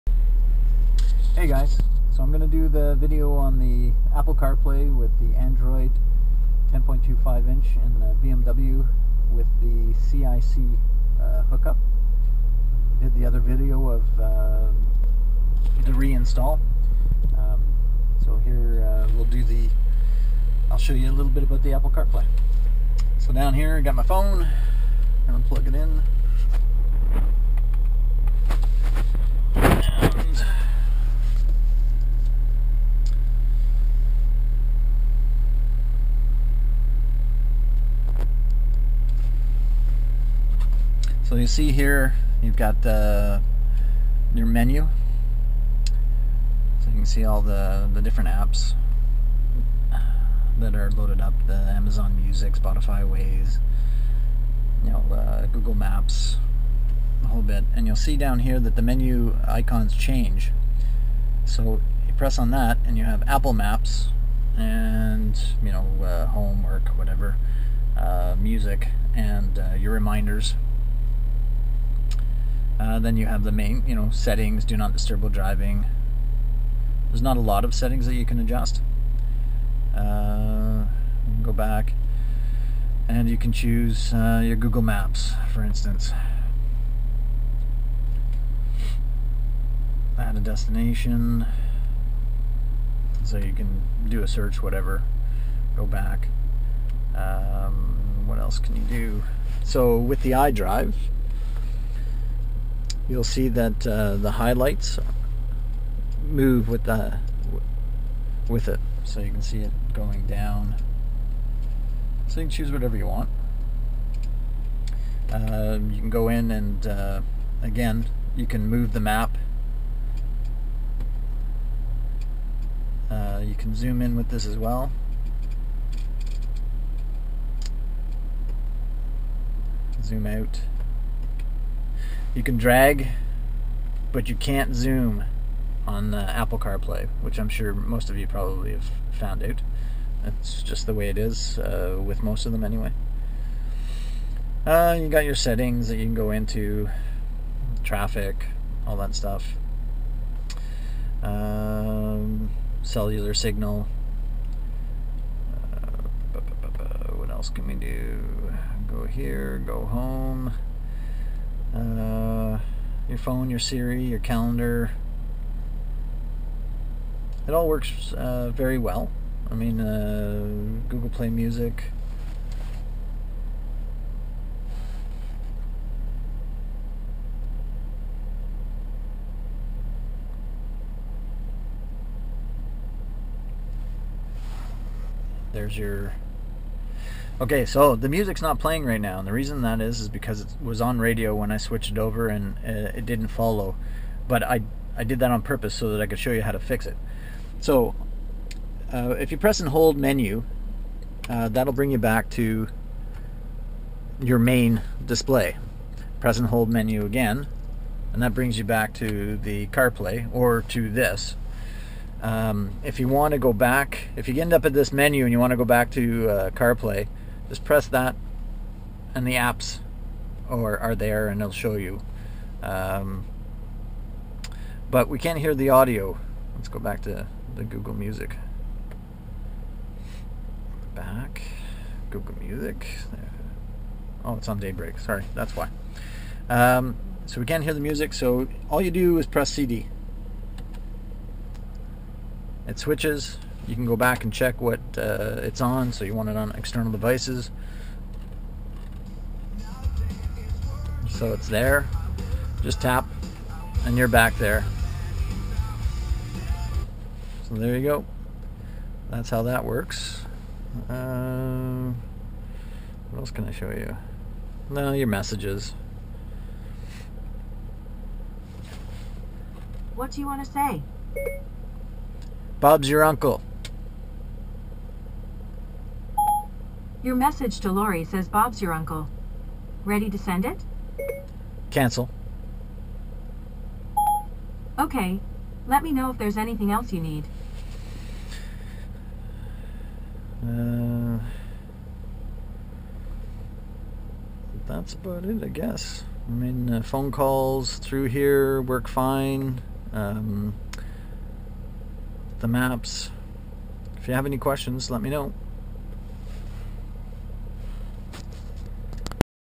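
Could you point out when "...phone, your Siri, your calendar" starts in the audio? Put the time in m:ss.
2:43.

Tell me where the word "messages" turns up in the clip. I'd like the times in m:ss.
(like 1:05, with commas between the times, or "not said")
4:25, 4:37.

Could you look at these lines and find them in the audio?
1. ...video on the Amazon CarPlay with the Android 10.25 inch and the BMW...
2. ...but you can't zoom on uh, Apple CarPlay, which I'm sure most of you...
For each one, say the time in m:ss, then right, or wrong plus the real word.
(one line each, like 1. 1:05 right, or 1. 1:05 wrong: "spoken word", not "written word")
1. 0:02 wrong: "Apple", not "Amazon"
2. 2:14 right.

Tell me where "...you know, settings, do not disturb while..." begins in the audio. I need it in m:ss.
1:13.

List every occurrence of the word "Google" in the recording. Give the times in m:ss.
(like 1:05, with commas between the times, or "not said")
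0:55, 1:24, 2:50, 3:47, 3:52.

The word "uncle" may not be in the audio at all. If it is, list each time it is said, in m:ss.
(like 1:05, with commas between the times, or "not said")
4:33, 4:38.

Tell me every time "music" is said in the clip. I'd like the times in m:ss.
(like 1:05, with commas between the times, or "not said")
0:52, 1:08, 2:51, 3:08, 3:47, 3:52, 3:57.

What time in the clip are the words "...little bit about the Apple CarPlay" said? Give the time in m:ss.
0:21.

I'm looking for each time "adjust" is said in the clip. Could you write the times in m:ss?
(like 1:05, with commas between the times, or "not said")
1:18.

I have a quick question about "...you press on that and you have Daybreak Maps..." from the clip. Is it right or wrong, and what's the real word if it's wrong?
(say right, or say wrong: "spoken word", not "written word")
wrong: "Apple", not "Daybreak".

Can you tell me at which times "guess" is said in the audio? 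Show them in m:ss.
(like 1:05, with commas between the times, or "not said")
4:55.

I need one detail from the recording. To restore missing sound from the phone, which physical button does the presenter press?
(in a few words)
CD.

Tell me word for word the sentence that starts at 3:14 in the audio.
But I, I did that on purpose so that I could show you how to fix it.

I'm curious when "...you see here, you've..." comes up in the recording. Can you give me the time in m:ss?
0:41.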